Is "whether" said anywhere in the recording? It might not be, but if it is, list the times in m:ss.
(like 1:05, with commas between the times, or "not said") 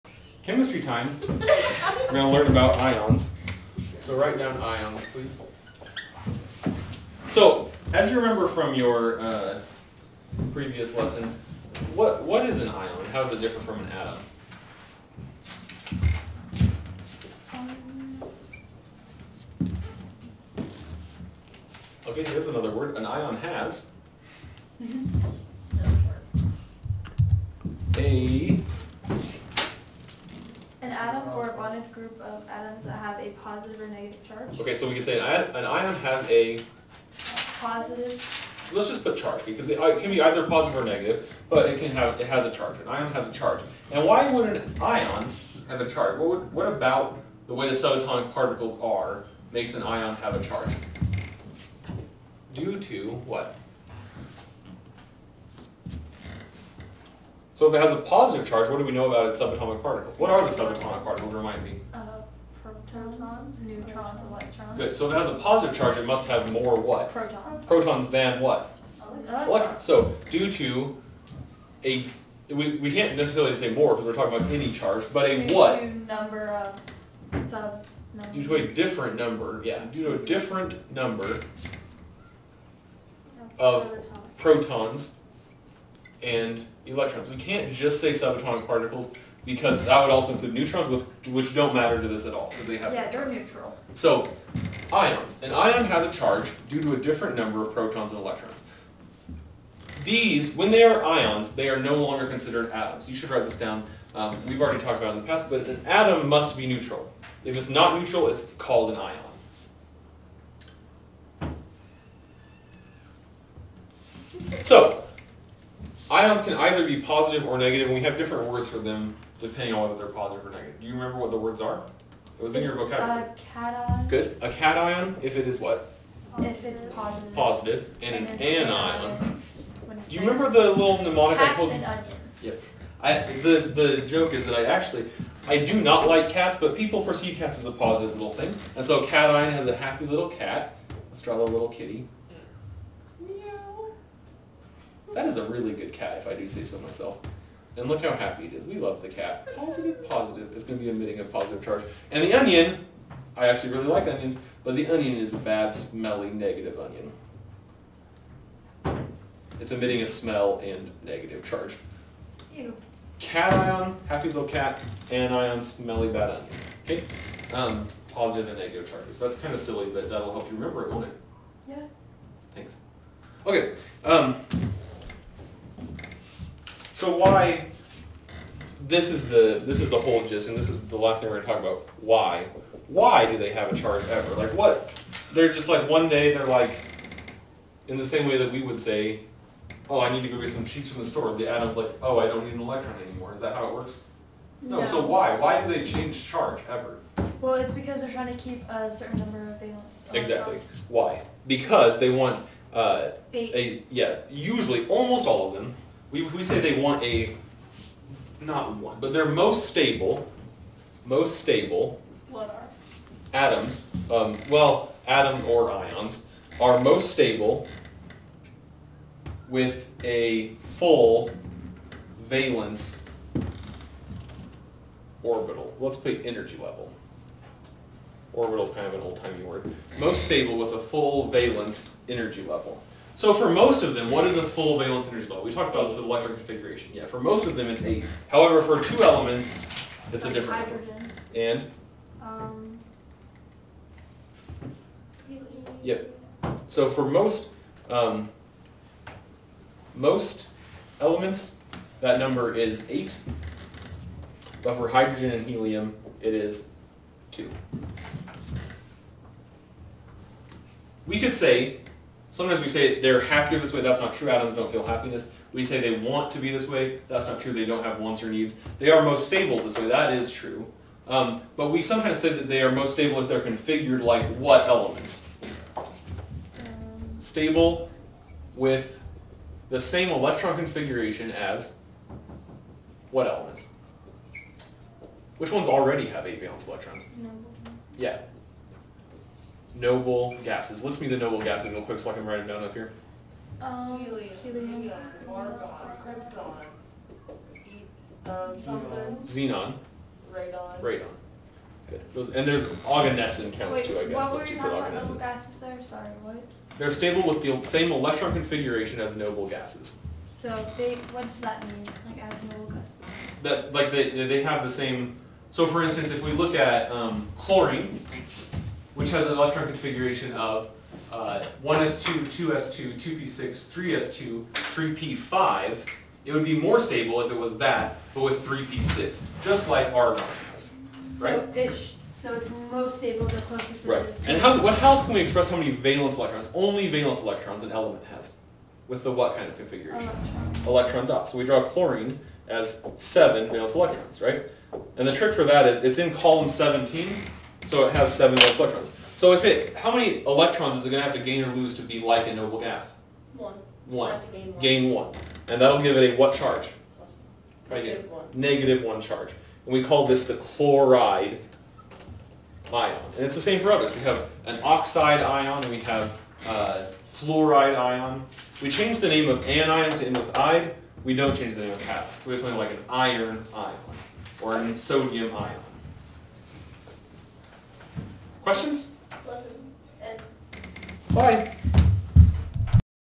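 1:59.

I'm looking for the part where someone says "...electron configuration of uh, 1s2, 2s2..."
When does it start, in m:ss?
5:19.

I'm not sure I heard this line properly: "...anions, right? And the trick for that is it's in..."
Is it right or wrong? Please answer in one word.
wrong.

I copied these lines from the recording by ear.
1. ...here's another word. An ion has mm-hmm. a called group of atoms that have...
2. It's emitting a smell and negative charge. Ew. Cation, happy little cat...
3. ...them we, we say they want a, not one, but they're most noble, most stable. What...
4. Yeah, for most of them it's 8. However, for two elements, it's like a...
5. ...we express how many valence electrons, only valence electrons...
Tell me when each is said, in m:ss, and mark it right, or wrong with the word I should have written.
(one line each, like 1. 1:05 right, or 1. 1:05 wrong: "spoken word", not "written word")
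1. 0:22 wrong: "bonded", not "called"
2. 2:39 right
3. 3:25 wrong: "stable", not "noble"
4. 3:56 right
5. 5:35 right.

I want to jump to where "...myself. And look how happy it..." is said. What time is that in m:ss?
2:26.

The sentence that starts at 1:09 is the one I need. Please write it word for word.
So due to a, we, we can't necessarily say more because we're talking about any charge, but a due what?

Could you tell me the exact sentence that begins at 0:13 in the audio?
How does it differ from an atom?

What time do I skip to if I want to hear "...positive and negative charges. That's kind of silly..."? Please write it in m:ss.
2:48.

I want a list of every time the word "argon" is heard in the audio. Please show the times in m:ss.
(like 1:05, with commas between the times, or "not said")
4:55, 5:29.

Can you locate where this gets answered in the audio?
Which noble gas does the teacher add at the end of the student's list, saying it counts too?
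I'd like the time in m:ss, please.
5:02.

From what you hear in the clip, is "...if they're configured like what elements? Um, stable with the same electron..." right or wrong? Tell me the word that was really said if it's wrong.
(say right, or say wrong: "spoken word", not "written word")
right.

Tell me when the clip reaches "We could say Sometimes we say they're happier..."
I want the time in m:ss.
4:21.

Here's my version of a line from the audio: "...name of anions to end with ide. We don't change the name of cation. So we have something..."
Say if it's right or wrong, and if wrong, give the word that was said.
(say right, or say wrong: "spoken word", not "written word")
right.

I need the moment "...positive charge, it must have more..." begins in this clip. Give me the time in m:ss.
1:05.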